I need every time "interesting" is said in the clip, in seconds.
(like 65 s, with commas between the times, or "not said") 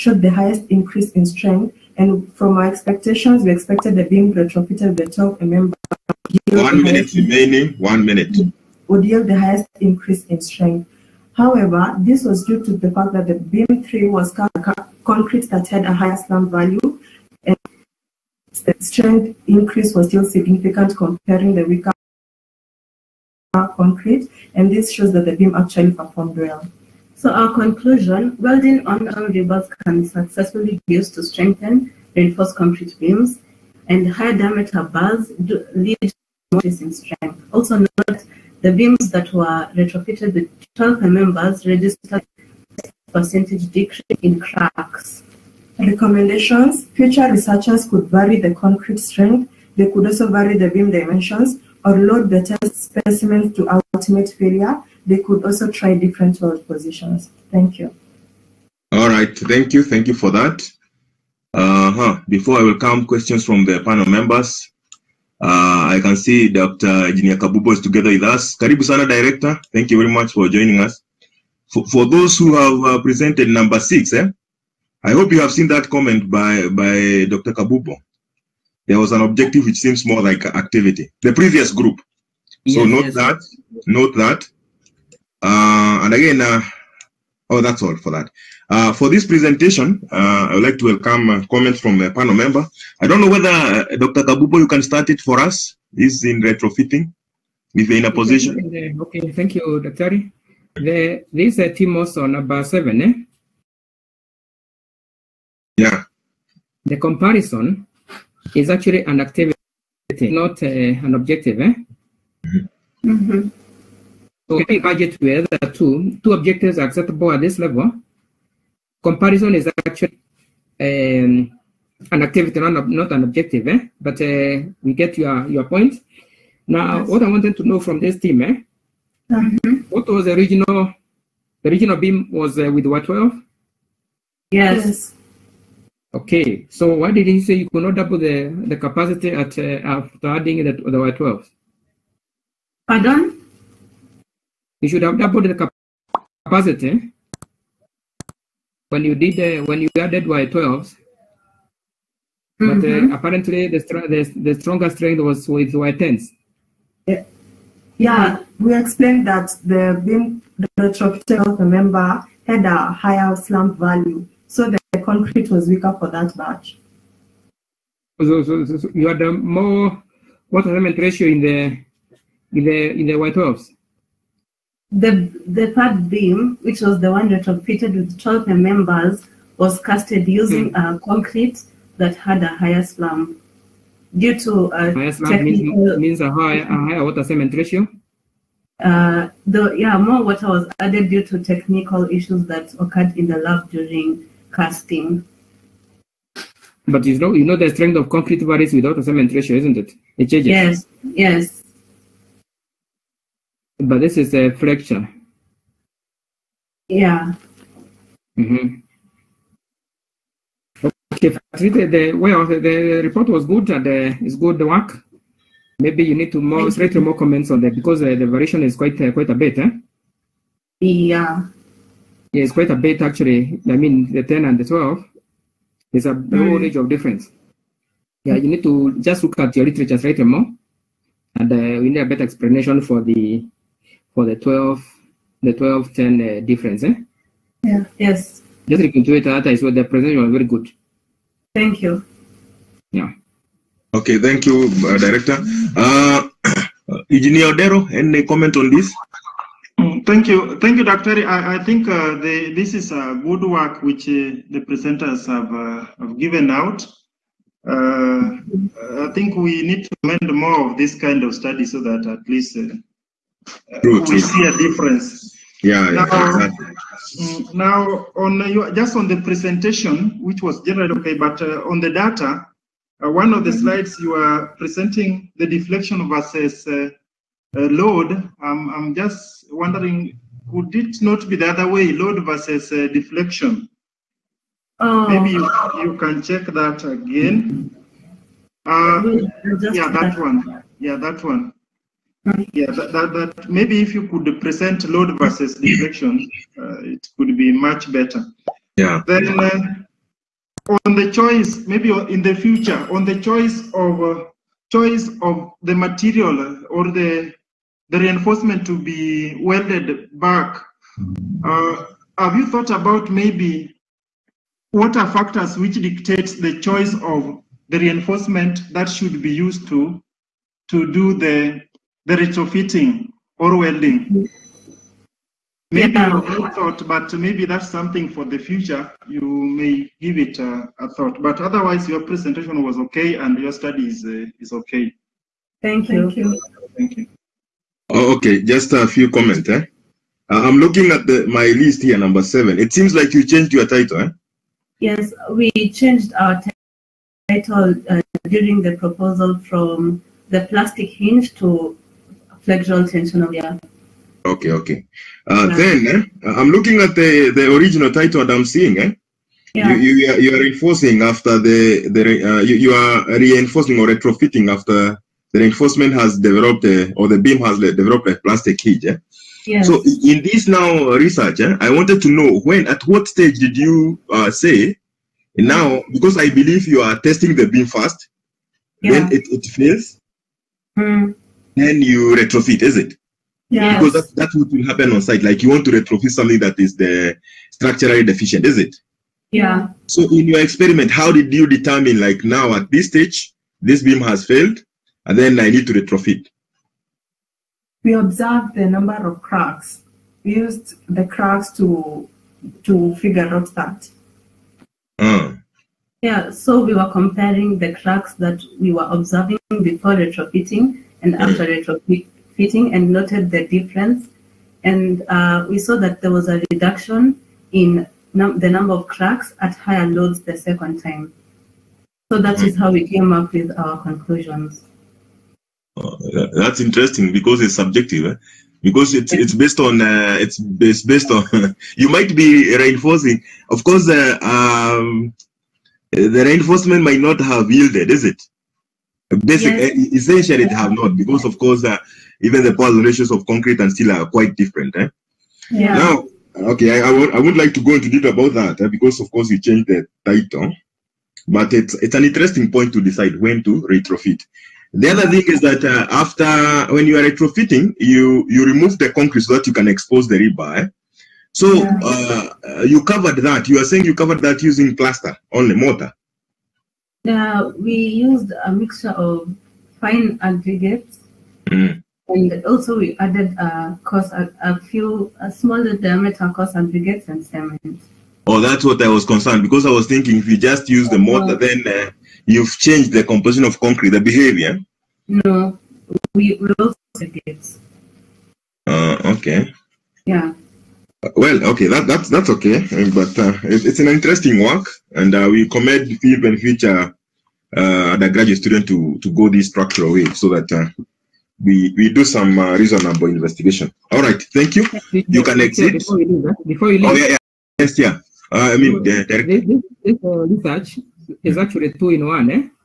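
426 s, 452 s, 493 s.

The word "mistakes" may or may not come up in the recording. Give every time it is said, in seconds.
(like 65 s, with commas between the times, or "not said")
not said.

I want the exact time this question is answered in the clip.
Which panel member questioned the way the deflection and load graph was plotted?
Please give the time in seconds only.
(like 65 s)
247 s.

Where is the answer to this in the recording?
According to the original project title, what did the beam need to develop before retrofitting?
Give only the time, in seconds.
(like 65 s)
350 s.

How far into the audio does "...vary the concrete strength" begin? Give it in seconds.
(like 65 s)
48 s.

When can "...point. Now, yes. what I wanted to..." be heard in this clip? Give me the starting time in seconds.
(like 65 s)
125 s.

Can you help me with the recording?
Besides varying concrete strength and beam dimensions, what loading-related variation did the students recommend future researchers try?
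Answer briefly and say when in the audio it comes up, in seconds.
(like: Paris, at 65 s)
different load positions, at 55 s.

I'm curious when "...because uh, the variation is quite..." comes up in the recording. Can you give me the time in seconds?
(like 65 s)
217 s.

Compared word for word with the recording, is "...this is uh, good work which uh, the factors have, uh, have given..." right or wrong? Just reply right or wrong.
wrong.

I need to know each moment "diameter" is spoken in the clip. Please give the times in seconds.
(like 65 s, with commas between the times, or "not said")
34 s, 475 s.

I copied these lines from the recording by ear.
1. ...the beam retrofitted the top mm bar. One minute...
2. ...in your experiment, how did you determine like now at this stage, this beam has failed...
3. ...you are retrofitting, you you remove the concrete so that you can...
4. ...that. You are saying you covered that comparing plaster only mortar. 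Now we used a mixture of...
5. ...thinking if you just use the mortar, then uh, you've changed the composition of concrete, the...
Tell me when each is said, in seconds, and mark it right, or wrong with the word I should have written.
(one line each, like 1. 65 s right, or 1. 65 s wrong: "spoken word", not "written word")
1. 3 s right
2. 390 s right
3. 456 s right
4. 463 s wrong: "using", not "comparing"
5. 479 s right.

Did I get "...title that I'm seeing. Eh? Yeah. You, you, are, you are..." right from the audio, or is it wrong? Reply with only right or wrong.
right.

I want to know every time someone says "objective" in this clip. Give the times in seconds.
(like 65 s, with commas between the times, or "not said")
79 s, 111 s, 116 s, 123 s.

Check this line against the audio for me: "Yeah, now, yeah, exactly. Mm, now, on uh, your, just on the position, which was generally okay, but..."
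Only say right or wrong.
wrong.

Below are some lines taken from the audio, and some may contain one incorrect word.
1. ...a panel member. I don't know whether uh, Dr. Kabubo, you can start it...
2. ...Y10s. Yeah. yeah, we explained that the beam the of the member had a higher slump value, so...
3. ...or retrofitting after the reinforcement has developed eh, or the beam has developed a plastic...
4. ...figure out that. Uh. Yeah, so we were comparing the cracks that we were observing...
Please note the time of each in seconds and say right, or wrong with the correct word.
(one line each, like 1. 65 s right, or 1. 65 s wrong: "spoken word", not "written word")
1. 92 s right
2. 155 s right
3. 363 s right
4. 402 s right.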